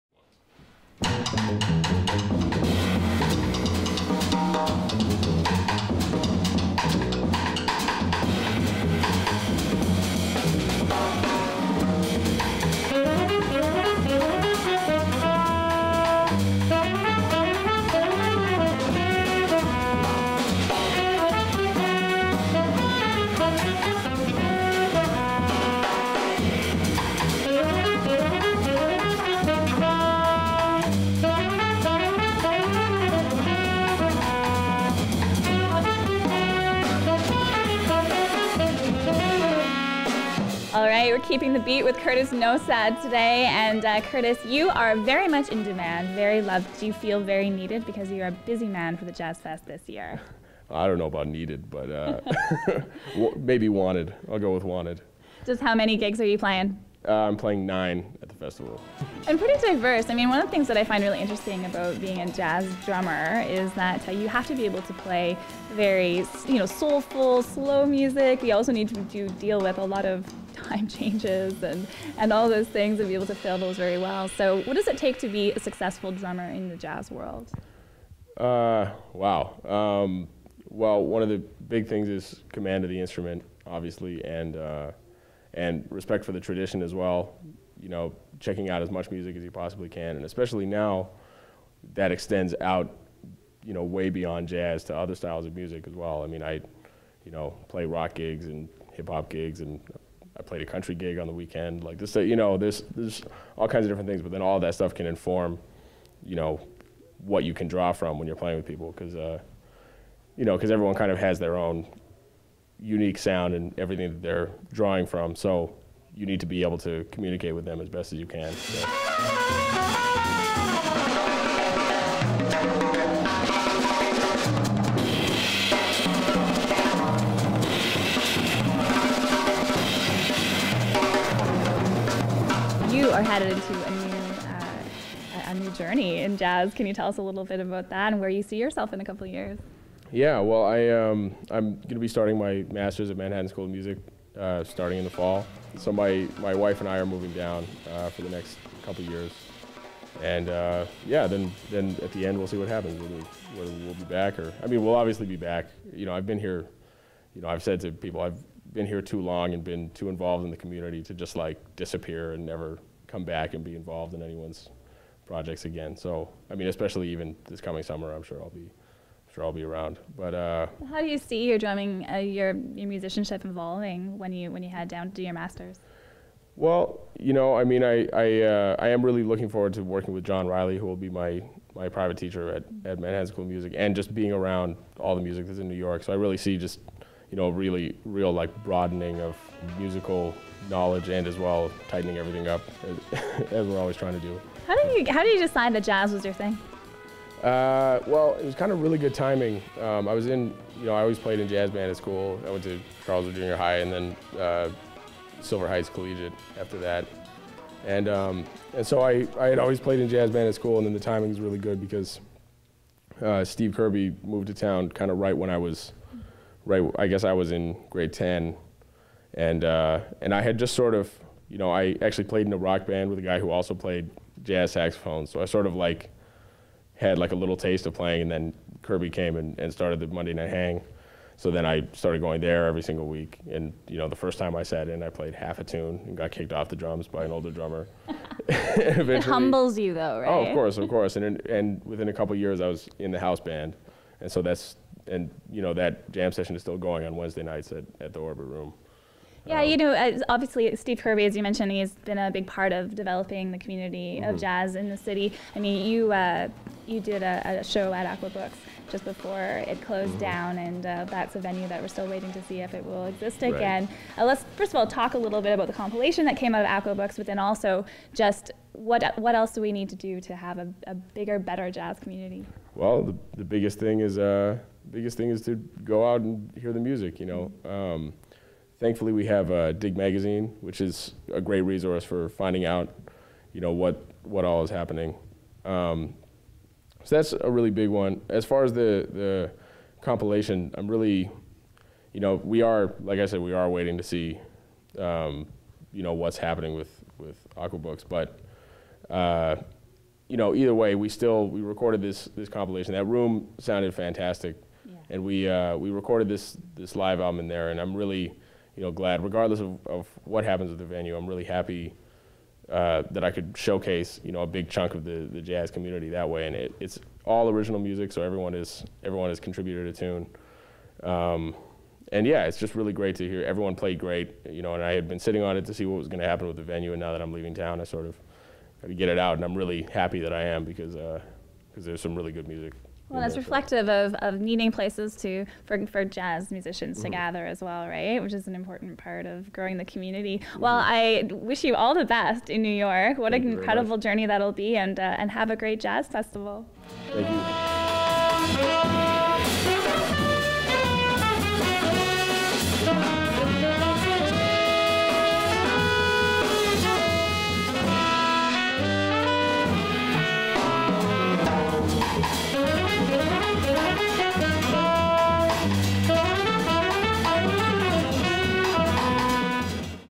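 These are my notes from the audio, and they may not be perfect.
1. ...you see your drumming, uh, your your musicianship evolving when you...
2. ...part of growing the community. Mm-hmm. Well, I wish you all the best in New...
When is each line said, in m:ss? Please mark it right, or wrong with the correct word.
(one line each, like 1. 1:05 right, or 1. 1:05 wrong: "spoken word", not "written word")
1. 2:51 right
2. 5:38 right.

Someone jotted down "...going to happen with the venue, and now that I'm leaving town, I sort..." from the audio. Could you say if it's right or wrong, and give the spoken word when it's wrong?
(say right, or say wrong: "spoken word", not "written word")
right.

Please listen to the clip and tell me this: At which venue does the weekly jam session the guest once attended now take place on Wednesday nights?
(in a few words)
Orbit Room.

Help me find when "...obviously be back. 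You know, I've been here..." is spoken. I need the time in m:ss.
2:34.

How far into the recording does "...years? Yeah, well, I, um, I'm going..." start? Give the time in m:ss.
2:19.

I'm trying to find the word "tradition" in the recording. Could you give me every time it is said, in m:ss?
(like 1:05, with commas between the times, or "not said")
1:26.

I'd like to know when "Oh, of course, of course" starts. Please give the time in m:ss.
4:00.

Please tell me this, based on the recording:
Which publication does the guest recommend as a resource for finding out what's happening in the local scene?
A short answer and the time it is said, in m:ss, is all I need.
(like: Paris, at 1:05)
Dig Magazine, at 4:39.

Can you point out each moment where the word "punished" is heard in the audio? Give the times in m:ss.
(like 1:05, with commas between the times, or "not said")
not said.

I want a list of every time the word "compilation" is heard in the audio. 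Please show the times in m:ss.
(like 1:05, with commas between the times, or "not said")
4:25, 4:50, 5:02.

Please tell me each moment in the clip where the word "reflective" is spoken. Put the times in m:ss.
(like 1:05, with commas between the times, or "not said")
5:33.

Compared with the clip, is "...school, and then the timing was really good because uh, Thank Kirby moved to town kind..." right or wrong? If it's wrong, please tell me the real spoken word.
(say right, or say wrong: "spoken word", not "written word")
wrong: "Steve", not "Thank".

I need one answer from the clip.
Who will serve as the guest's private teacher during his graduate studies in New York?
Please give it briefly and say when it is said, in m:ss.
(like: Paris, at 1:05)
John Riley, at 3:00.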